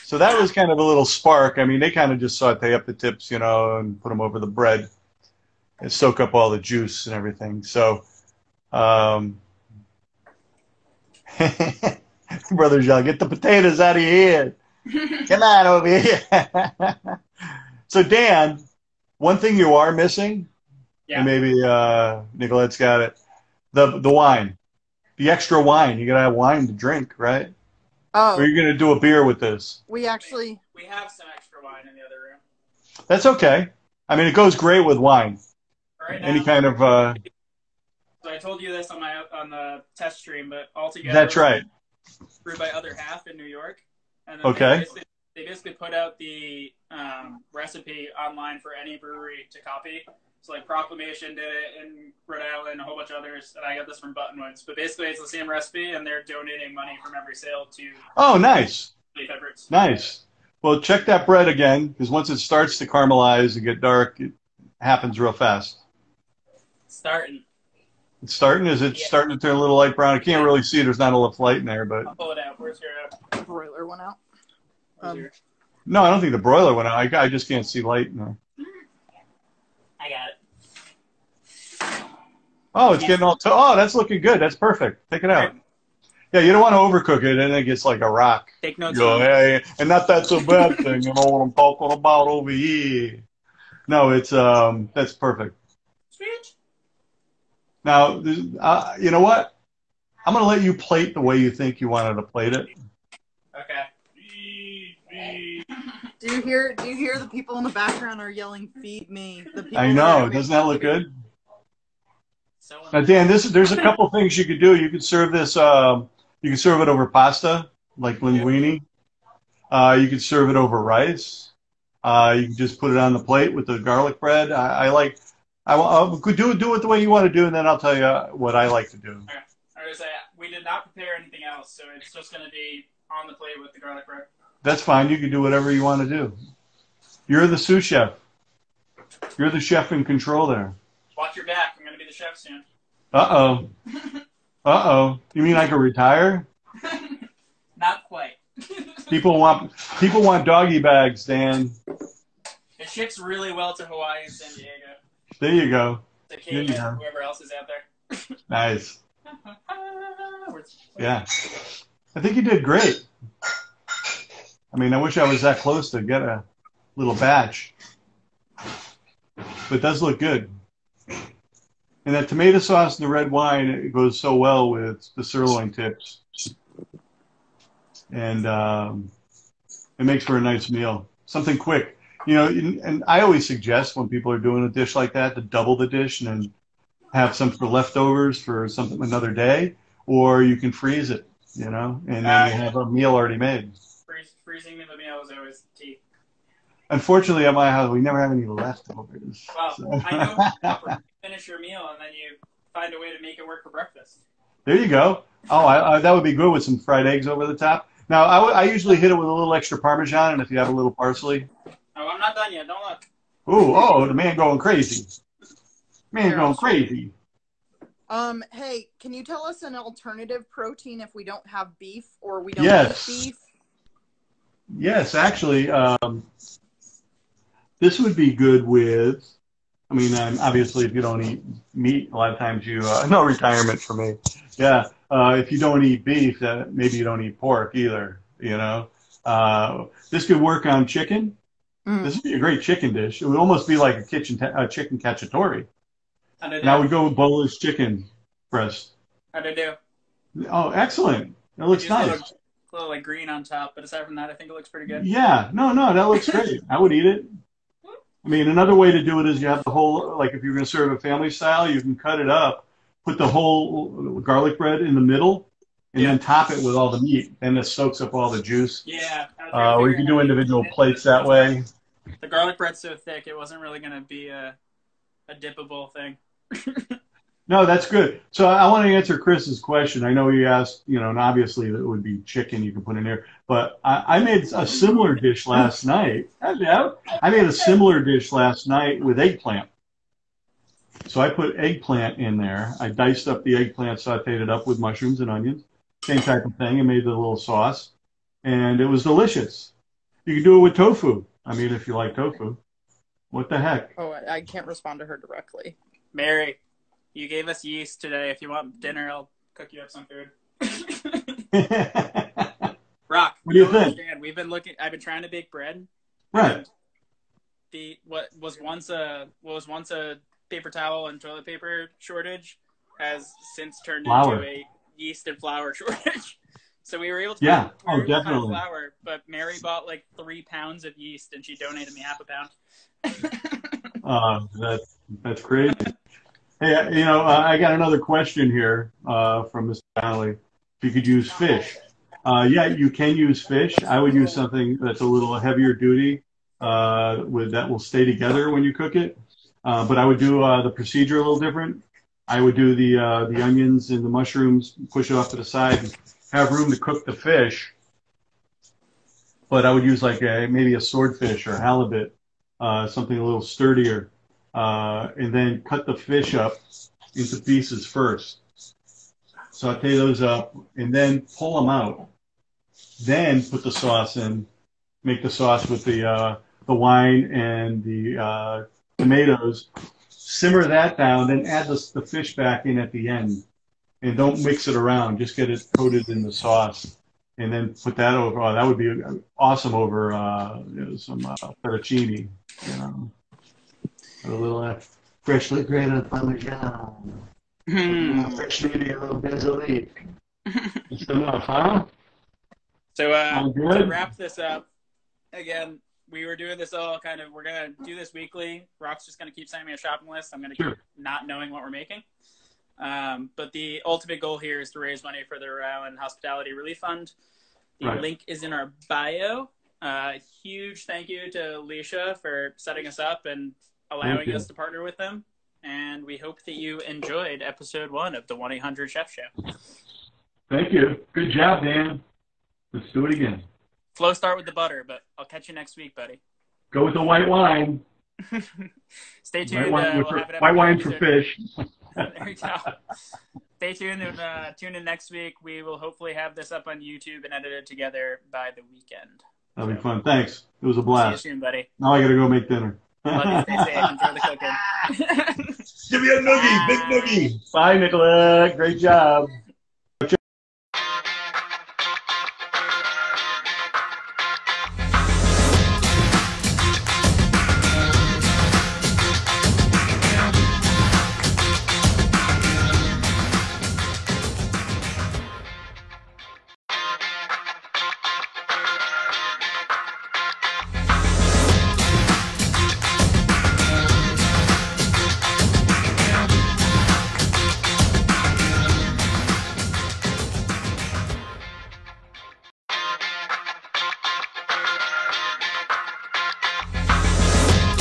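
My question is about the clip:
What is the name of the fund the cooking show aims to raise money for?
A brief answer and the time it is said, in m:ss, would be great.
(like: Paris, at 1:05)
Rhode Hospitality Relief Fund, at 6:55.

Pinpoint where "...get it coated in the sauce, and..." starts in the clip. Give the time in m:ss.
6:25.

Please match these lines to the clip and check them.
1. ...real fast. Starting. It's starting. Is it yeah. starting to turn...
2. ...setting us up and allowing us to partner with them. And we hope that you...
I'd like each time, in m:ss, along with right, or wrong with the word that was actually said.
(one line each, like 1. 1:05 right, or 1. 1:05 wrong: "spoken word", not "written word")
1. 1:05 right
2. 7:02 right.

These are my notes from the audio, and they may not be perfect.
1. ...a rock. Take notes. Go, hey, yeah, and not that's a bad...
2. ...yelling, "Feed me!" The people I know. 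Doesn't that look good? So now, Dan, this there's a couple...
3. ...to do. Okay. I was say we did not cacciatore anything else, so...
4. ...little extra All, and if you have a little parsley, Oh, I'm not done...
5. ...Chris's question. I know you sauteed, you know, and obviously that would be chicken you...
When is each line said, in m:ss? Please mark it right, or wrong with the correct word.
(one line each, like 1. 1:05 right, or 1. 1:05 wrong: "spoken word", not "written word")
1. 1:27 right
2. 1:48 right
3. 2:08 wrong: "prepare", not "cacciatore"
4. 3:29 wrong: "Parmesan", not "All"
5. 4:39 wrong: "asked", not "sauteed".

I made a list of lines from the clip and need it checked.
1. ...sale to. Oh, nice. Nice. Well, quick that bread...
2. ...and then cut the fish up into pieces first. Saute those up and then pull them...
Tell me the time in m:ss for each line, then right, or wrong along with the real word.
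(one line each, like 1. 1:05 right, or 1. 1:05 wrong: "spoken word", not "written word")
1. 0:57 wrong: "check", not "quick"
2. 6:05 right.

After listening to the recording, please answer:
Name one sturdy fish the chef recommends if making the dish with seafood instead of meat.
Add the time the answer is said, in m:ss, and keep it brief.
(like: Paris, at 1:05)
swordfish, at 6:00.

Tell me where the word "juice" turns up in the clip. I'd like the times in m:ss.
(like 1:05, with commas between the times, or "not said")
0:06, 4:28.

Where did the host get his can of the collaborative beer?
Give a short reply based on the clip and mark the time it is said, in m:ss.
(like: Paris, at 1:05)
Buttonwoods, at 0:54.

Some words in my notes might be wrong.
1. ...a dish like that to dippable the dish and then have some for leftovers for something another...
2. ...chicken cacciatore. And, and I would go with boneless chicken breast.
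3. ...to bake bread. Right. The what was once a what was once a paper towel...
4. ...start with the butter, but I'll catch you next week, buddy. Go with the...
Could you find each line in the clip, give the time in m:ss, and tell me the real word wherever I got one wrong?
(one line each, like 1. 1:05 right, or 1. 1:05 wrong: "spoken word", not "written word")
1. 3:04 wrong: "double", not "dippable"
2. 4:04 right
3. 5:15 right
4. 7:14 right.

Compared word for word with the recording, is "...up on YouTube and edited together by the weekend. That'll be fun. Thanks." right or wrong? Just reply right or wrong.
right.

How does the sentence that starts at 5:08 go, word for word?
If you want dinner, I'll cook you up some food.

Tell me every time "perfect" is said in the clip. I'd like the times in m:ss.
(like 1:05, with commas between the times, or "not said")
1:24, 1:35.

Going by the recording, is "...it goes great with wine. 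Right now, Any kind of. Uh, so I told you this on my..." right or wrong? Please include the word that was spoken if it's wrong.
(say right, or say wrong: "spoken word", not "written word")
right.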